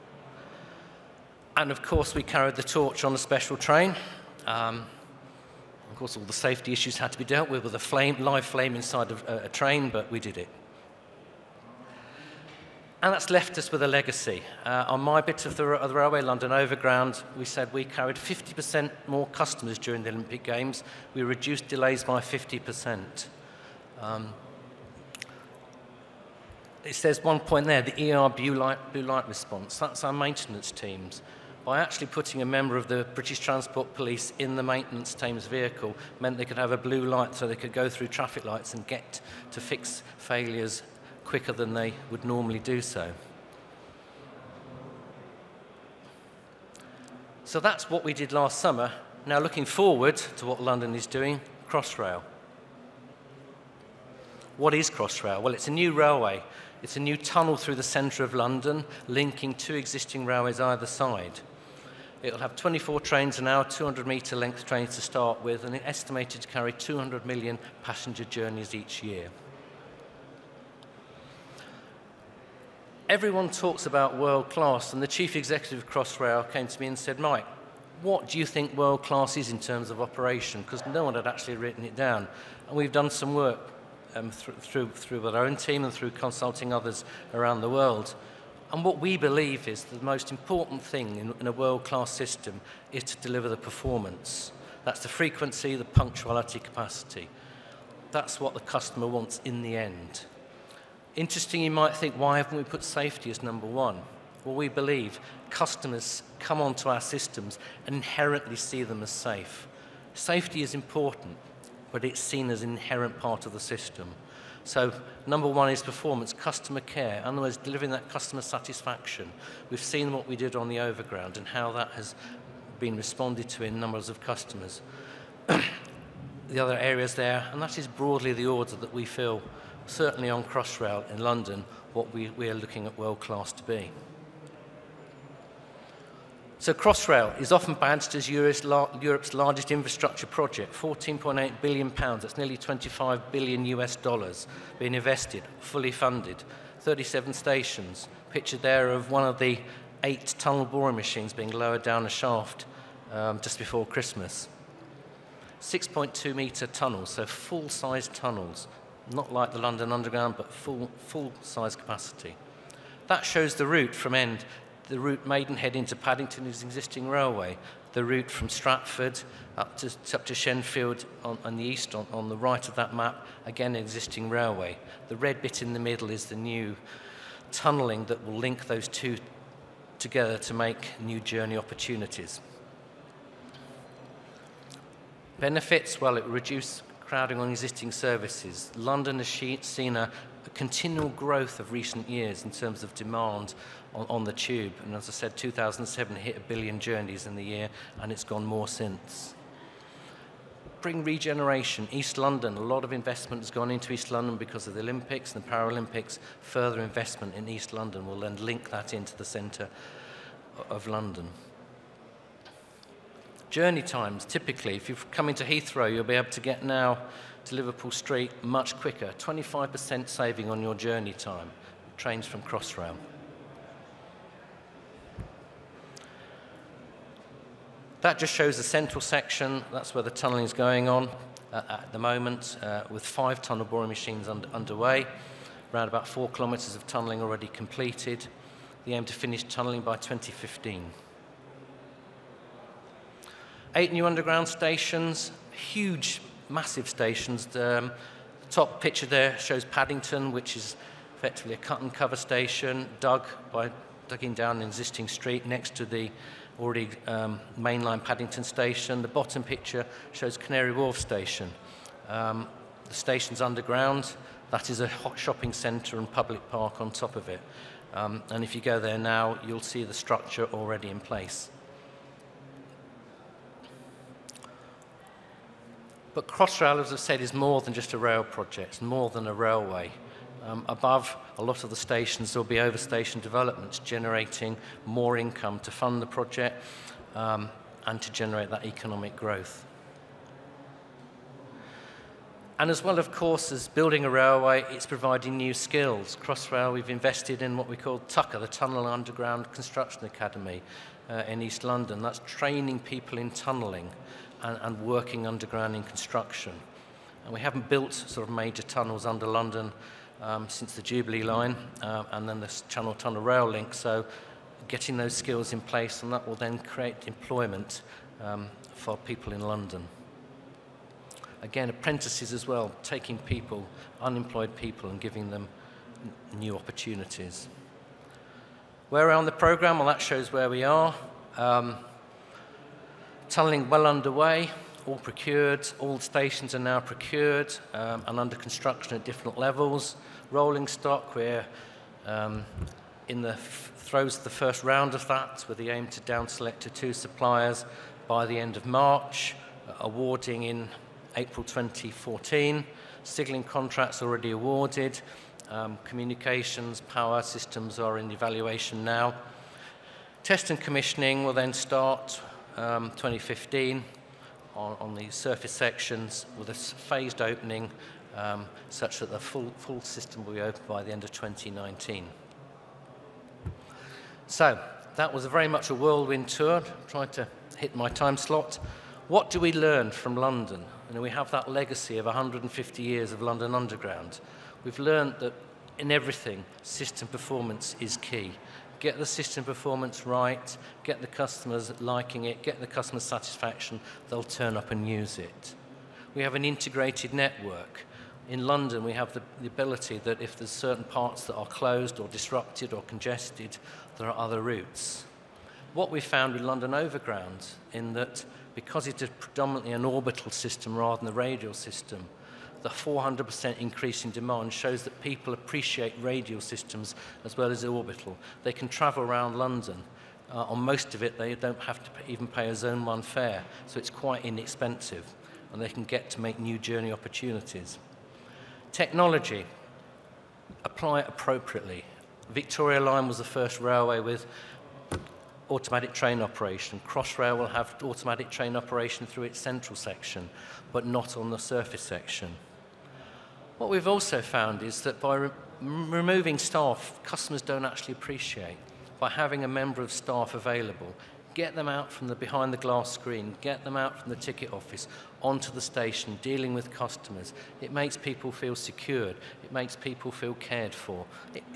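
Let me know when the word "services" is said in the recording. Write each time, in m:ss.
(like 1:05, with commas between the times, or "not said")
3:07.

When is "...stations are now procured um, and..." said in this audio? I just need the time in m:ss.
5:35.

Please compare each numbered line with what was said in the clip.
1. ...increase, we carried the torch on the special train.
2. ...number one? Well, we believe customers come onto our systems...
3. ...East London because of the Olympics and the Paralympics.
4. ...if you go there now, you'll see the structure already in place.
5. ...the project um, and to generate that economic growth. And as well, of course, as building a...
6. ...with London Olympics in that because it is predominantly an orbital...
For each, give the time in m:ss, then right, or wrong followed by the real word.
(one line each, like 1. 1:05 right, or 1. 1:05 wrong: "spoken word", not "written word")
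1. 0:01 wrong: "course", not "increase"
2. 1:43 right
3. 3:23 right
4. 4:28 right
5. 4:46 right
6. 6:46 wrong: "Overground", not "Olympics".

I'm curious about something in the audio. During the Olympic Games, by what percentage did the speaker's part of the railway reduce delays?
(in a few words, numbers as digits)
50%.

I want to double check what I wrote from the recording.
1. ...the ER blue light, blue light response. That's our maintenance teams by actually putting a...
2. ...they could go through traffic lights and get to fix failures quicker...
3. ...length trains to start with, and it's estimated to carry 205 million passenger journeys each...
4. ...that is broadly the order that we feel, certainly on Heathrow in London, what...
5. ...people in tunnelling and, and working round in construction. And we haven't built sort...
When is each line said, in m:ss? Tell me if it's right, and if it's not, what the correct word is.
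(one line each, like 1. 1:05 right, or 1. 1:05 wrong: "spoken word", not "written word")
1. 0:27 right
2. 0:37 right
3. 1:04 wrong: "200", not "205"
4. 2:07 wrong: "Crossrail", not "Heathrow"
5. 5:02 wrong: "underground", not "round".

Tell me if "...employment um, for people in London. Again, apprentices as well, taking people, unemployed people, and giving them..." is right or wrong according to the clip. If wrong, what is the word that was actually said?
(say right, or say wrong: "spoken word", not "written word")
right.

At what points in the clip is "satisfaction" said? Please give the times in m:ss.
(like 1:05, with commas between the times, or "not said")
1:58, 6:32.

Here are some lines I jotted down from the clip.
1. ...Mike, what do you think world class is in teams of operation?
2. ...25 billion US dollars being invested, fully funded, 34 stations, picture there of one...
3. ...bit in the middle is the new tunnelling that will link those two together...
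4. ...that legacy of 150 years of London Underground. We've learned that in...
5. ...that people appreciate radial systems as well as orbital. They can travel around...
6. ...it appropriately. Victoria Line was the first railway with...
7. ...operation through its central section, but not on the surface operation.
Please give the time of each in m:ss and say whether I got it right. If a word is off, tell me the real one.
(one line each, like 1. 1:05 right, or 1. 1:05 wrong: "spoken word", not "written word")
1. 1:17 wrong: "terms", not "teams"
2. 2:22 wrong: "37", not "34"
3. 2:55 right
4. 6:21 right
5. 6:54 right
6. 7:11 right
7. 7:18 wrong: "section", not "operation".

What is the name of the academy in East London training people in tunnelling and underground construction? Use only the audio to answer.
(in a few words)
Tunnel Underground Construction Academy.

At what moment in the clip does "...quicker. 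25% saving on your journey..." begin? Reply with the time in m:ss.
3:38.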